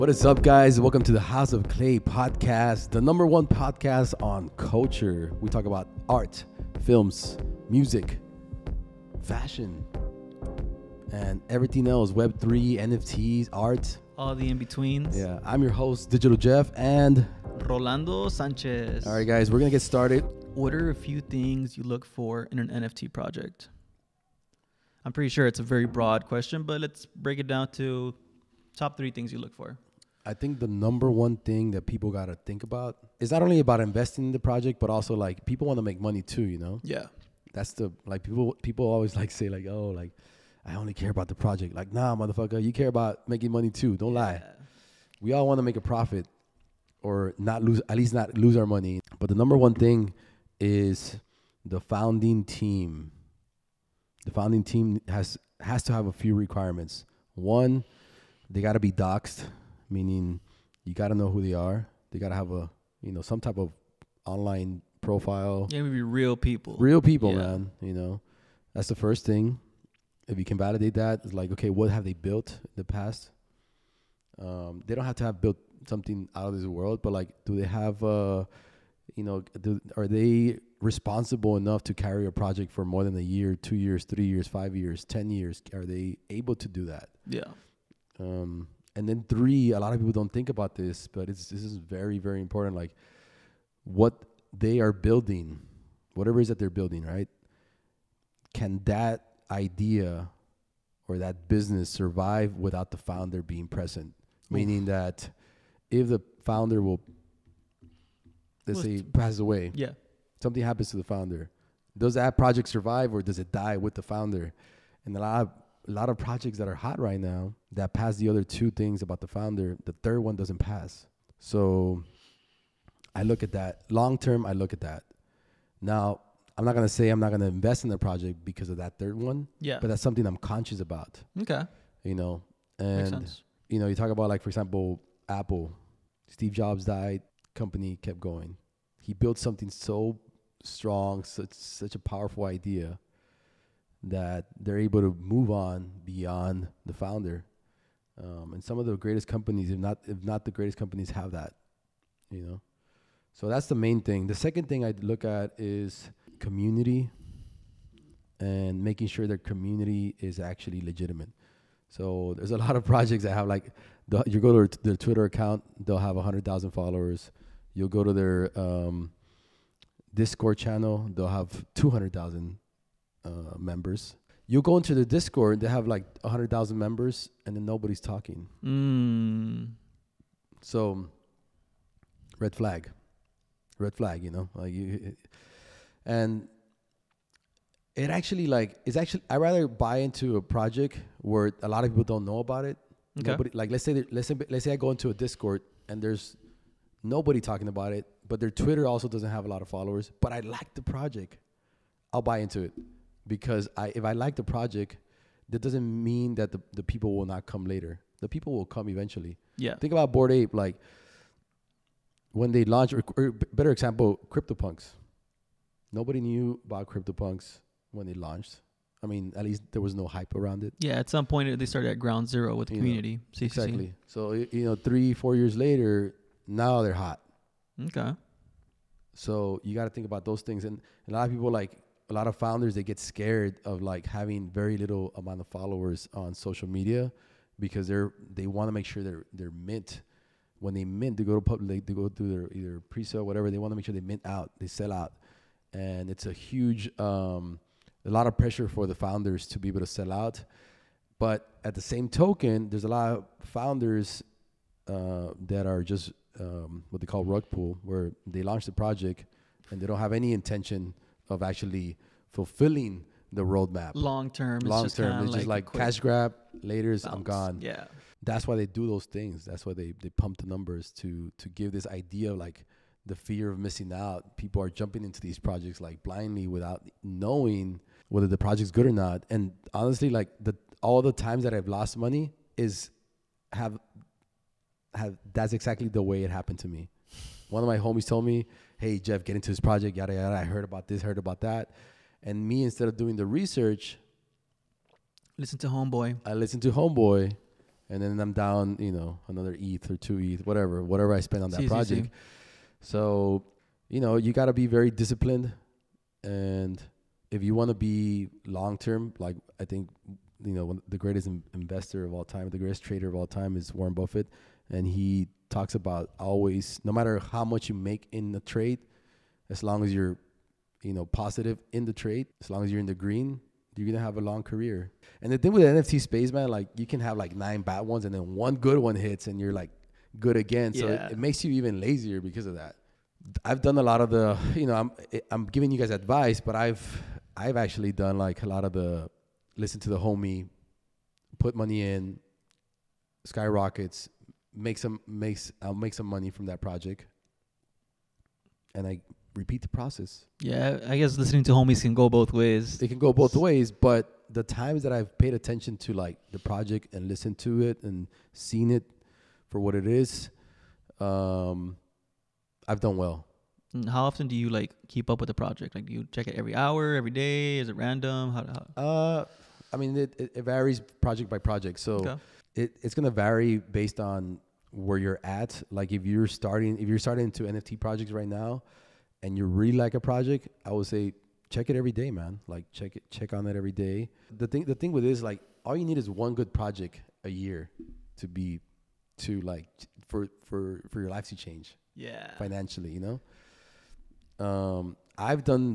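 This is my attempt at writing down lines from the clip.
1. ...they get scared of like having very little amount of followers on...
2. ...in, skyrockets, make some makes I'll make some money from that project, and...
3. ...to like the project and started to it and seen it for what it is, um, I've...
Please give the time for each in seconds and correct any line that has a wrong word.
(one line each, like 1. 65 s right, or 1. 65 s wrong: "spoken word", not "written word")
1. 232 s right
2. 341 s right
3. 355 s wrong: "listened", not "started".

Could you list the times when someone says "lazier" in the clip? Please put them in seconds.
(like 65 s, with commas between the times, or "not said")
331 s.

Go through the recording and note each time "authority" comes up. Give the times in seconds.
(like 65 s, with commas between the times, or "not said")
not said.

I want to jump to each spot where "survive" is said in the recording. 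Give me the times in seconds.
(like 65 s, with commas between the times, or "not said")
101 s, 112 s.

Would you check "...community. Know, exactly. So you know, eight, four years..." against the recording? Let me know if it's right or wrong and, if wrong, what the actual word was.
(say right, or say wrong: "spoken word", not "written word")
wrong: "three", not "eight".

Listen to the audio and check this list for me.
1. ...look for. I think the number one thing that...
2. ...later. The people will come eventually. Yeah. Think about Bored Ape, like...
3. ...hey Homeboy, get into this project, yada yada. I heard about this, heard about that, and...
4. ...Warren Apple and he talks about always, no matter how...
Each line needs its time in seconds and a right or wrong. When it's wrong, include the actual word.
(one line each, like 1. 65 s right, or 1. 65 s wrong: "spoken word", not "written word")
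1. 29 s right
2. 207 s right
3. 288 s wrong: "Jeff", not "Homeboy"
4. 313 s wrong: "Buffett", not "Apple".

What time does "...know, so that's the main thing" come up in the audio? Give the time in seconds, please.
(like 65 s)
152 s.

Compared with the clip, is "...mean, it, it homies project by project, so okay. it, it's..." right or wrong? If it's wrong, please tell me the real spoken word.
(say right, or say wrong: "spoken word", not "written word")
wrong: "varies", not "homies".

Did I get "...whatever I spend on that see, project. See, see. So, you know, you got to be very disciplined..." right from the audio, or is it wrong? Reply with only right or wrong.
right.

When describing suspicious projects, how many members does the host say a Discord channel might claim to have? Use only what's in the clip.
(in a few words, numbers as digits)
200,000.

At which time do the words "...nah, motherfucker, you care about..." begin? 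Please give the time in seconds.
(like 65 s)
41 s.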